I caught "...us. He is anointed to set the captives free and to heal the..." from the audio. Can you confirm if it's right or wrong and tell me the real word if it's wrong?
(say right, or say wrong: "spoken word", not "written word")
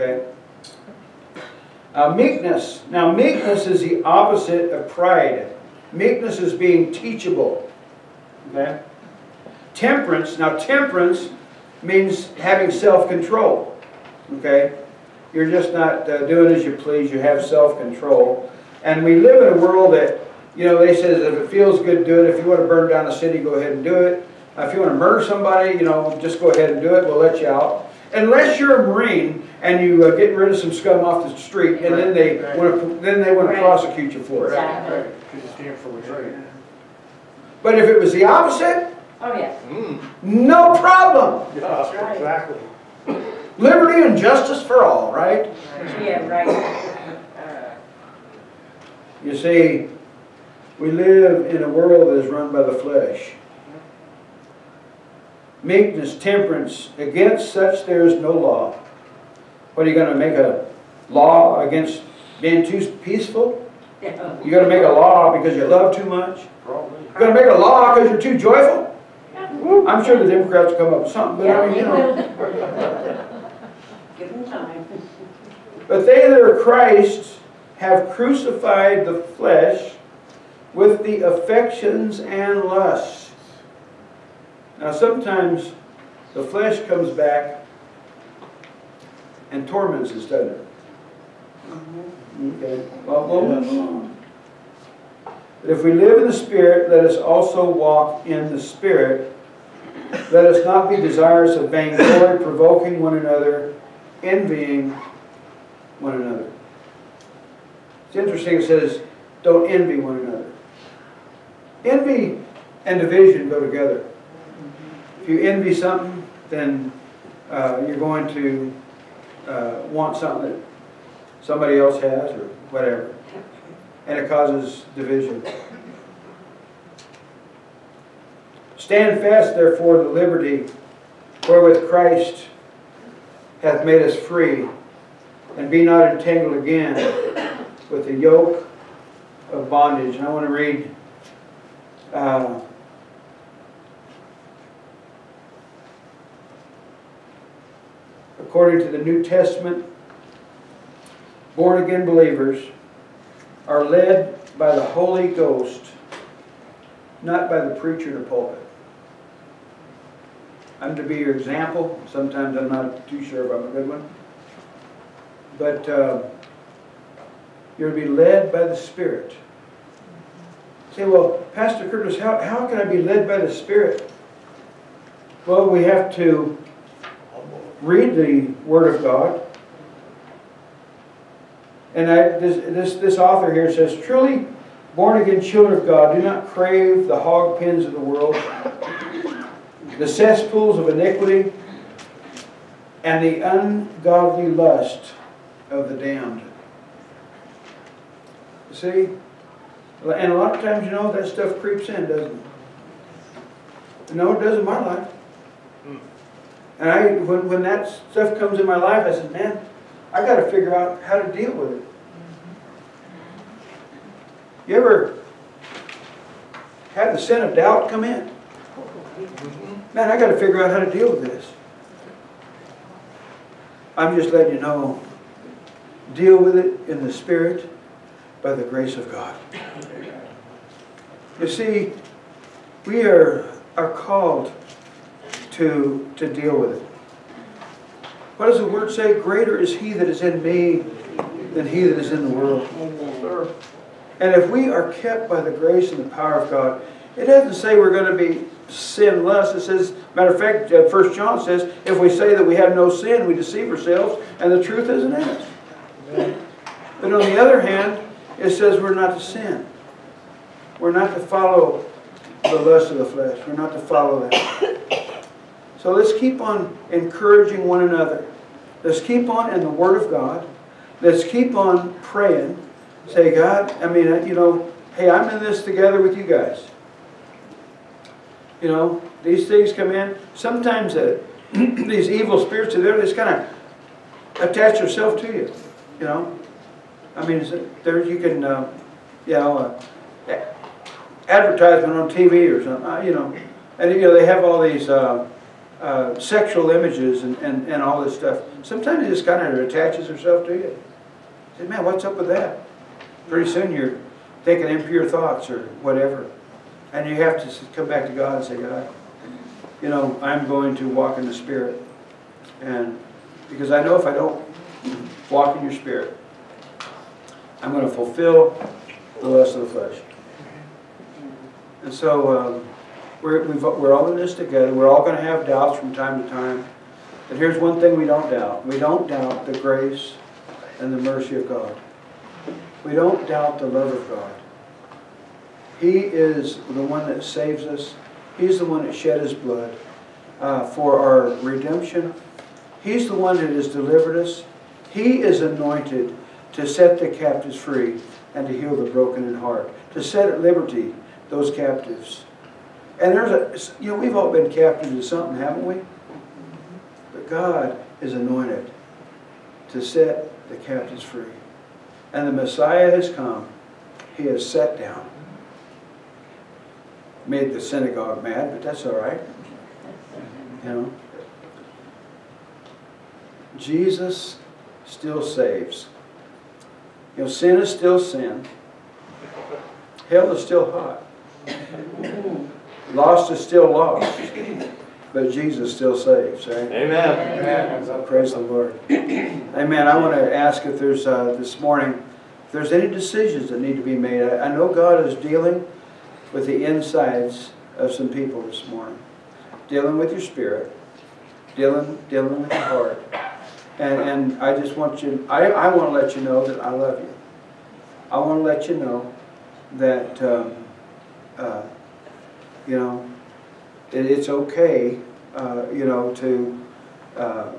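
right.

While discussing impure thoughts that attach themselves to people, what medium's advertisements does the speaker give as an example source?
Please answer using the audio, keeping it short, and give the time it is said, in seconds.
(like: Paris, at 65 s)
TV, at 292 s.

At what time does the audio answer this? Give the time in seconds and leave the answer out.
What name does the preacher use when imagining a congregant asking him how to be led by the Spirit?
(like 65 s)
171 s.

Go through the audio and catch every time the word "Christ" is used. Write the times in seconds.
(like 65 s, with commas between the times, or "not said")
76 s, 131 s.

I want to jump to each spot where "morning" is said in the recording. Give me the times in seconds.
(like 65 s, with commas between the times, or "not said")
391 s, 398 s.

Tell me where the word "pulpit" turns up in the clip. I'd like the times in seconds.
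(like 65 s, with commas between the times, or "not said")
158 s.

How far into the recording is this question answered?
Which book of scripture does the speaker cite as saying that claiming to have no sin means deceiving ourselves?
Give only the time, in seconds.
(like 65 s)
250 s.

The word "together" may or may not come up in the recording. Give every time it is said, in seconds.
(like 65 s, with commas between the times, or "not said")
113 s, 275 s, 324 s.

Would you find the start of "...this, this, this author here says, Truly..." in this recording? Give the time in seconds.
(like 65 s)
182 s.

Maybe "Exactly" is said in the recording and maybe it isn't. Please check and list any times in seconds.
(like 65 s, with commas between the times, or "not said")
34 s, 42 s.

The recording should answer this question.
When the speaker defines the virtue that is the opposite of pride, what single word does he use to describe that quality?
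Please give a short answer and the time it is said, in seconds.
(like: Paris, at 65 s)
Teachable, at 6 s.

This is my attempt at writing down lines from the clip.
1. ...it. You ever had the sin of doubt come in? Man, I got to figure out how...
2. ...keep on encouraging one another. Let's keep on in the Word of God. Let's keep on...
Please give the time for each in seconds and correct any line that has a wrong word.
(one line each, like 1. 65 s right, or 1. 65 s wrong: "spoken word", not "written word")
1. 211 s right
2. 266 s right.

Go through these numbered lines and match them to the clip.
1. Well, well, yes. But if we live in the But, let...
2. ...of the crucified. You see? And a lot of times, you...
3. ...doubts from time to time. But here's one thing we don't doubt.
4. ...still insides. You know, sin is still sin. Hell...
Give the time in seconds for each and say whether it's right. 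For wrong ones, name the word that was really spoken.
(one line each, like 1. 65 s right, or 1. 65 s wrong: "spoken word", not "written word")
1. 93 s wrong: "Spirit", not "But"
2. 195 s wrong: "damned", not "crucified"
3. 325 s right
4. 374 s wrong: "saves", not "insides".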